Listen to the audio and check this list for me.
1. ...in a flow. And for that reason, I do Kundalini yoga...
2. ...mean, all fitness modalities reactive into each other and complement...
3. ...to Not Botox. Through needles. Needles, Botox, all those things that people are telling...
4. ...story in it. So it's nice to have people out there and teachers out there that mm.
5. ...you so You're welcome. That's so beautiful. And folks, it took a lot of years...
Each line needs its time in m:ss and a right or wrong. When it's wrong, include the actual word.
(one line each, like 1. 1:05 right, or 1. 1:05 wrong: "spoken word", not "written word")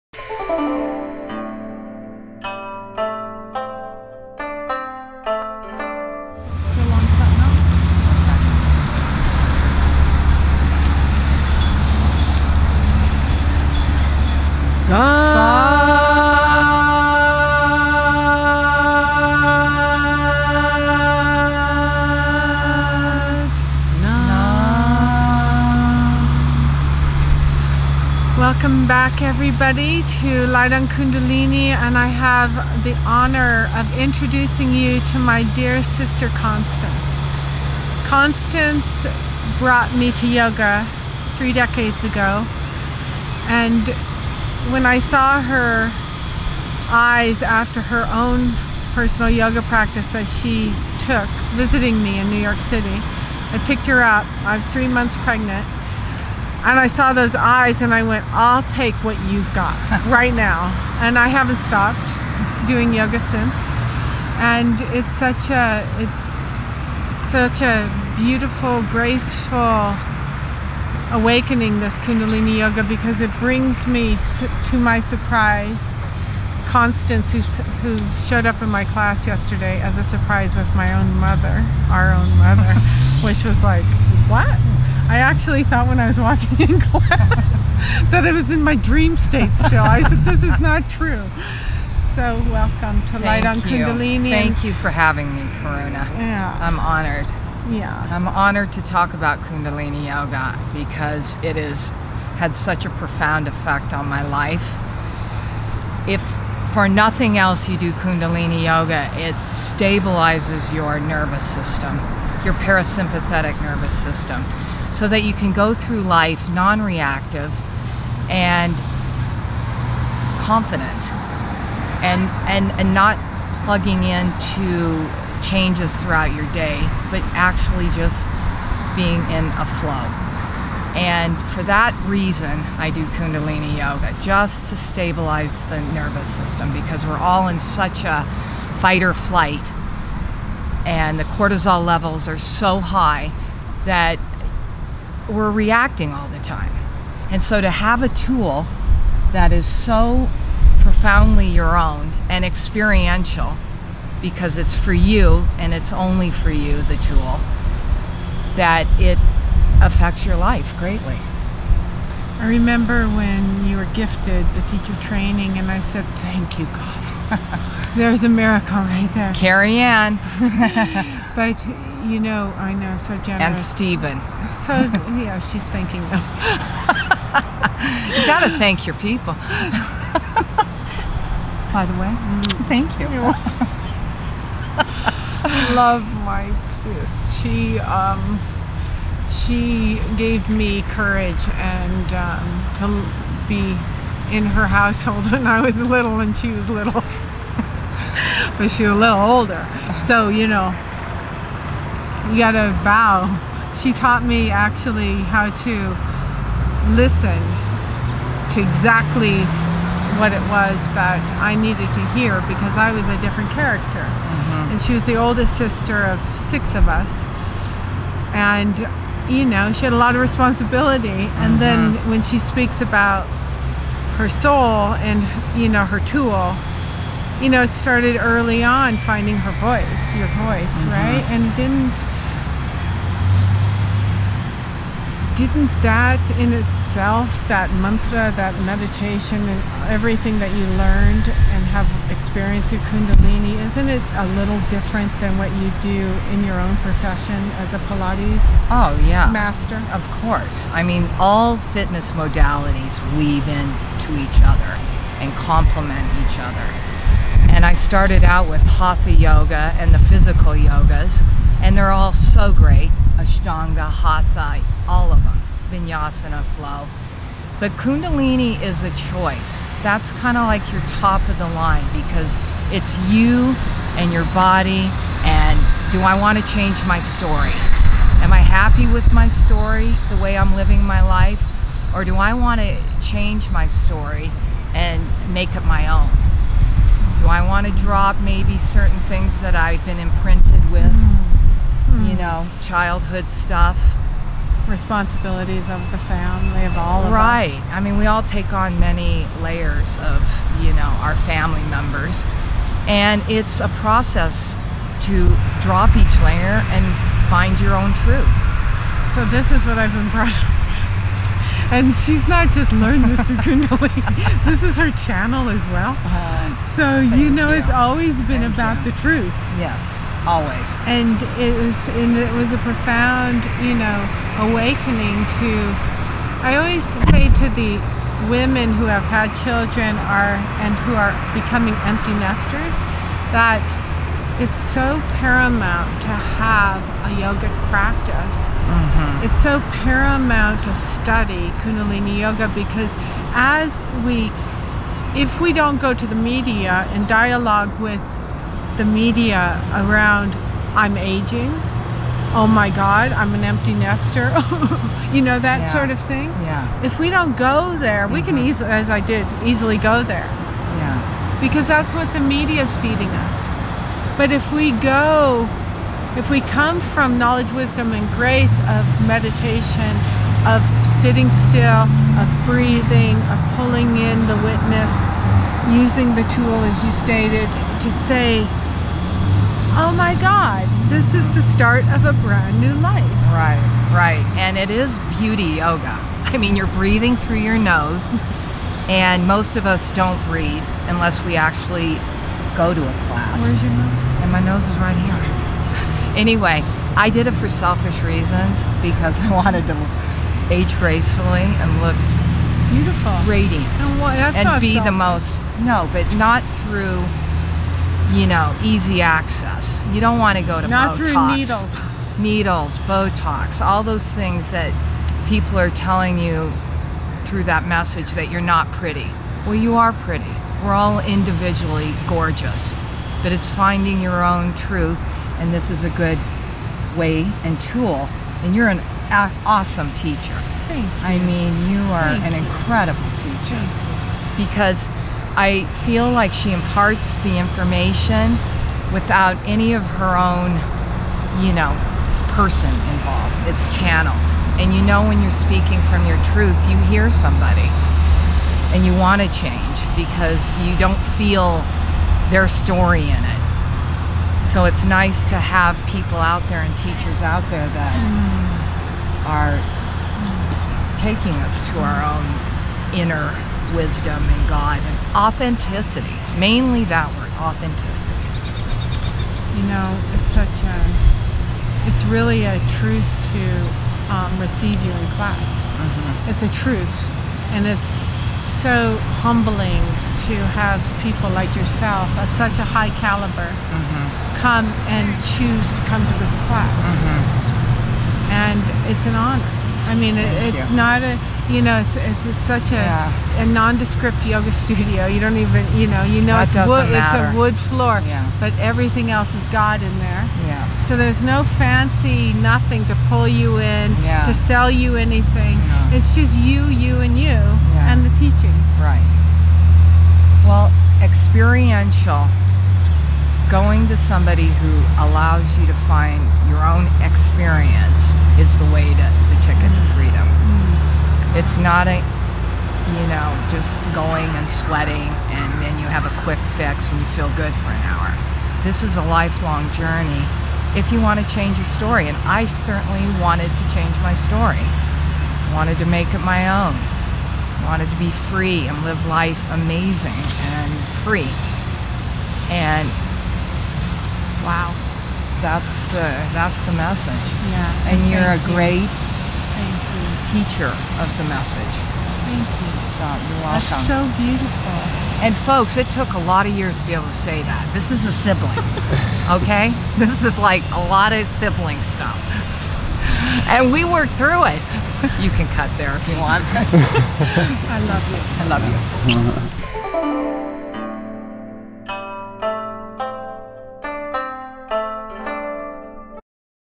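1. 2:09 right
2. 4:10 wrong: "weave", not "reactive"
3. 6:50 right
4. 7:32 right
5. 9:12 right.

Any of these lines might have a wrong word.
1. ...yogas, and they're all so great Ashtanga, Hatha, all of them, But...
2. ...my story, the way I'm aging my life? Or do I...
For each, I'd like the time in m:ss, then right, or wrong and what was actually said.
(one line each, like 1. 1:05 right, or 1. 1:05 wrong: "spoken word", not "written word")
1. 4:20 wrong: "Vinyasana", not "But"
2. 4:39 wrong: "living", not "aging".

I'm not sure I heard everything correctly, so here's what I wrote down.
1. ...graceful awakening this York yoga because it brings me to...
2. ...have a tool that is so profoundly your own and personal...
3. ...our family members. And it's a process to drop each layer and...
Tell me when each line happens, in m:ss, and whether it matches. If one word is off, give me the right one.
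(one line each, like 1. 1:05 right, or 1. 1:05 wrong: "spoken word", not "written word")
1. 1:08 wrong: "Kundalini", not "York"
2. 2:27 wrong: "experiential", not "personal"
3. 5:01 right.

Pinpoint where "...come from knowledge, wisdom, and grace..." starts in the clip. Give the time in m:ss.
6:06.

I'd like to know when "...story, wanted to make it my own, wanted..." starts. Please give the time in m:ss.
8:54.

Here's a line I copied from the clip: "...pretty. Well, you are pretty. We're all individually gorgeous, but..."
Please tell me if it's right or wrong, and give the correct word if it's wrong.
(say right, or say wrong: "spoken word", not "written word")
right.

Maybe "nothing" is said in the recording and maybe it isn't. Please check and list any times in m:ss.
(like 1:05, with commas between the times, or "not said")
1:46, 8:22.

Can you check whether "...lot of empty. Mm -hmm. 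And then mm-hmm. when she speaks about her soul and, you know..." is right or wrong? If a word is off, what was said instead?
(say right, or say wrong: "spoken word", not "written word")
wrong: "responsibility", not "empty".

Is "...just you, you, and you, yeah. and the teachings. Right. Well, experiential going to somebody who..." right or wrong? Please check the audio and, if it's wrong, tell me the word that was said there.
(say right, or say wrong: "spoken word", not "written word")
right.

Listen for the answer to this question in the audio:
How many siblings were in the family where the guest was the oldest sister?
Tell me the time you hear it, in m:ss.
3:36.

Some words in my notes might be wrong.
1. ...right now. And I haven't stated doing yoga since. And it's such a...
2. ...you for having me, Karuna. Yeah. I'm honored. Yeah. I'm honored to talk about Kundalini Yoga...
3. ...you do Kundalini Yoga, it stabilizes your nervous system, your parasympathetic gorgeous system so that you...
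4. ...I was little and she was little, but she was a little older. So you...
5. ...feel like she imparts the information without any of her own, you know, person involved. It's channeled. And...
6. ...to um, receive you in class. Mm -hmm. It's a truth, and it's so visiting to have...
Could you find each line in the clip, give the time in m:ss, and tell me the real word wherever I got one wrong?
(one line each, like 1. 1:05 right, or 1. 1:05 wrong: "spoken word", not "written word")
1. 1:00 wrong: "stopped", not "stated"
2. 1:34 right
3. 1:47 wrong: "nervous", not "gorgeous"
4. 3:15 right
5. 7:15 right
6. 7:53 wrong: "humbling", not "visiting".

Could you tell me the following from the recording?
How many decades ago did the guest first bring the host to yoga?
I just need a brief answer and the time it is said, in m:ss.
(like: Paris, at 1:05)
3, at 0:41.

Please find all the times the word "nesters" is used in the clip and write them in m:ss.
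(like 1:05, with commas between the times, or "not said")
5:32, 5:53.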